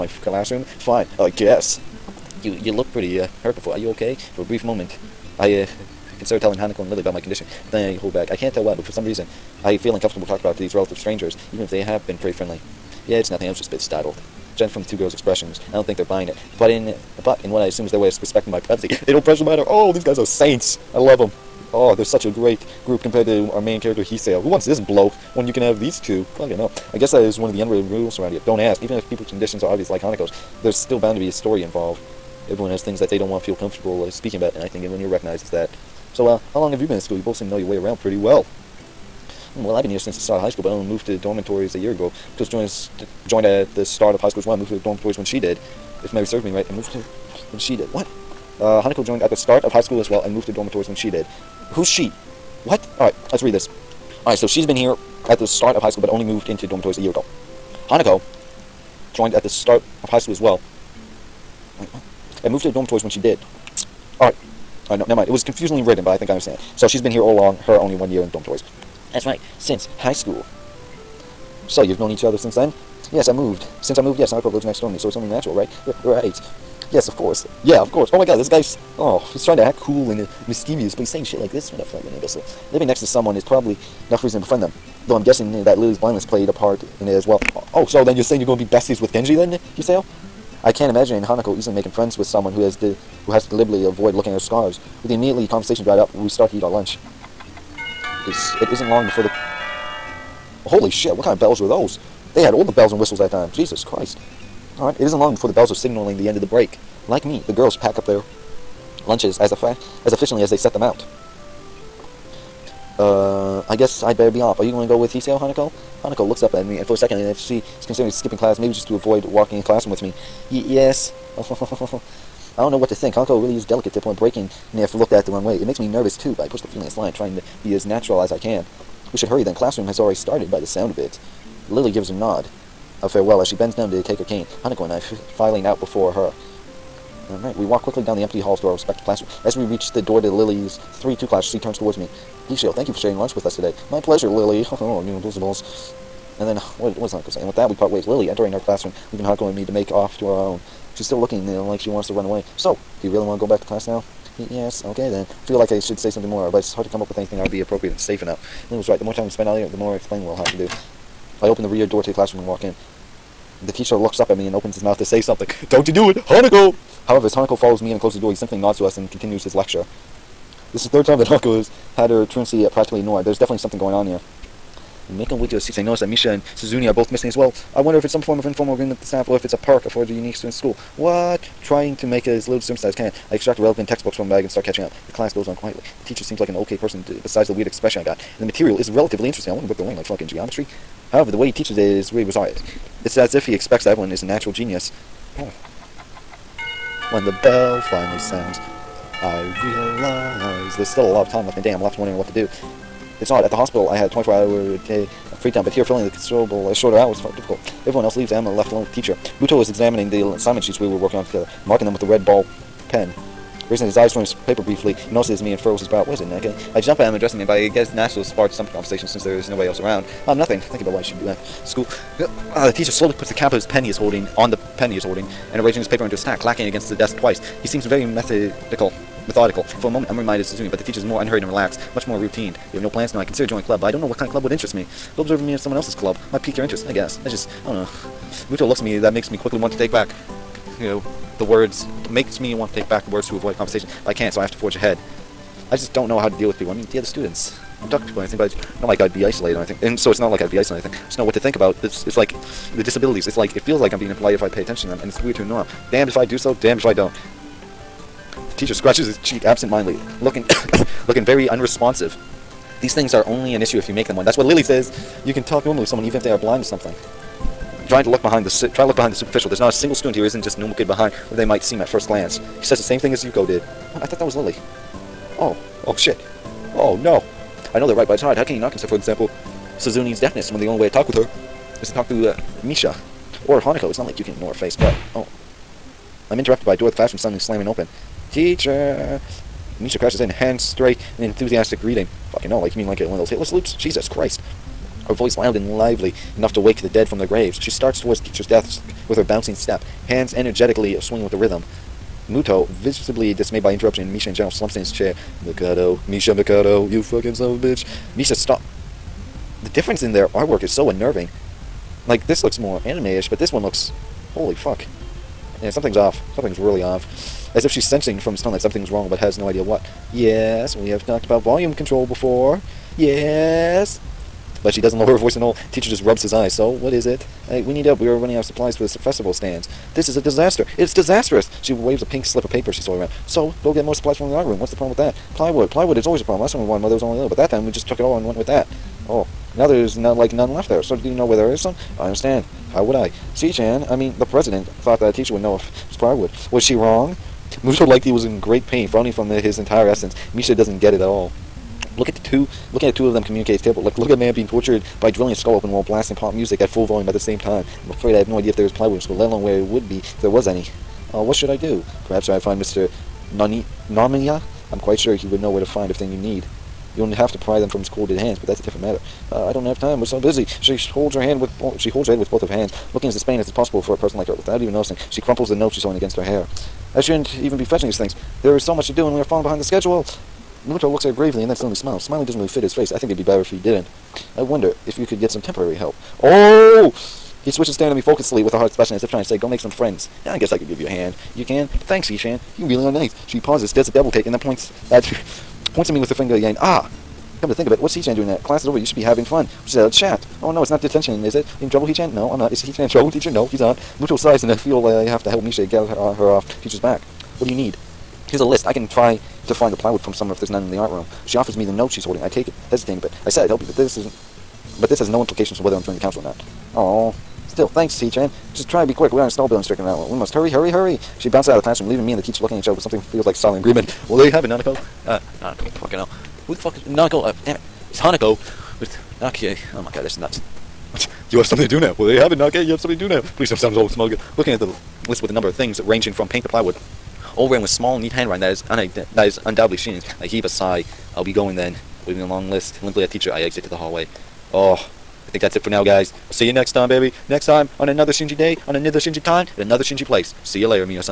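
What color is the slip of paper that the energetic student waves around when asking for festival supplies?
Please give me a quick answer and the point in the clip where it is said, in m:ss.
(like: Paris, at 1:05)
Pink, at 5:32.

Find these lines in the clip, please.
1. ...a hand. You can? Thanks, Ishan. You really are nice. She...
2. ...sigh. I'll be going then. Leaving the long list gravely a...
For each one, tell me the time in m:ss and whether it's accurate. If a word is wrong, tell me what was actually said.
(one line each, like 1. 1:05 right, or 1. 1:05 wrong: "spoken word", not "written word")
1. 6:30 right
2. 7:20 wrong: "limply", not "gravely".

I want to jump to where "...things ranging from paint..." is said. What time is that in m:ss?
7:15.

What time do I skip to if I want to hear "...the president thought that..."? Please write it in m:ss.
5:44.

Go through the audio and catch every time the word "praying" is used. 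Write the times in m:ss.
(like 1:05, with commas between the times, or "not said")
not said.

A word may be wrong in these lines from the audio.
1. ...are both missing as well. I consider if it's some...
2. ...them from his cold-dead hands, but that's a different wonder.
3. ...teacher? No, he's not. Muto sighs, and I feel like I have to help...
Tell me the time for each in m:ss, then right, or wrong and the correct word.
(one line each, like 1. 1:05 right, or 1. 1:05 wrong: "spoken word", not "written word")
1. 2:56 wrong: "wonder", not "consider"
2. 6:07 wrong: "matter", not "wonder"
3. 6:43 right.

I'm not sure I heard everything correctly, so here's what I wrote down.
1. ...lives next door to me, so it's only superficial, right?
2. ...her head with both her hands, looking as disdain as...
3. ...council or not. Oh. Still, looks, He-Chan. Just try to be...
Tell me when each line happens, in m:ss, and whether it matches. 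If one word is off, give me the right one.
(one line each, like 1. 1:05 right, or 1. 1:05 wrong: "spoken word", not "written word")
1. 1:14 wrong: "natural", not "superficial"
2. 6:12 right
3. 6:55 wrong: "thanks", not "looks".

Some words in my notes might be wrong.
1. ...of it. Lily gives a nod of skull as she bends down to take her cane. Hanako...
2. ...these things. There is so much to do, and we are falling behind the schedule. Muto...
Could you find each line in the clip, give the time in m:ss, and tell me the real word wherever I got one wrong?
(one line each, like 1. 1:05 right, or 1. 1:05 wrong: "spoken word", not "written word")
1. 2:10 wrong: "farewell", not "skull"
2. 6:17 right.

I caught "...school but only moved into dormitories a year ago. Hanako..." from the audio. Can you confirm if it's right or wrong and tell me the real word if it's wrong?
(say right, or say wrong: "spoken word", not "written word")
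right.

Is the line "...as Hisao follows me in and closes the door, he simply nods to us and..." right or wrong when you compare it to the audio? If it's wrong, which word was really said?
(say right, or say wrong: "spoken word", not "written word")
wrong: "Hanako", not "Hisao".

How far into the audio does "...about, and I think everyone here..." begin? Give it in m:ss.
0:34.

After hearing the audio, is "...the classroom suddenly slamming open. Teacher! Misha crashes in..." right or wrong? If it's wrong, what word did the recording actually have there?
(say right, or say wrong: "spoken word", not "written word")
right.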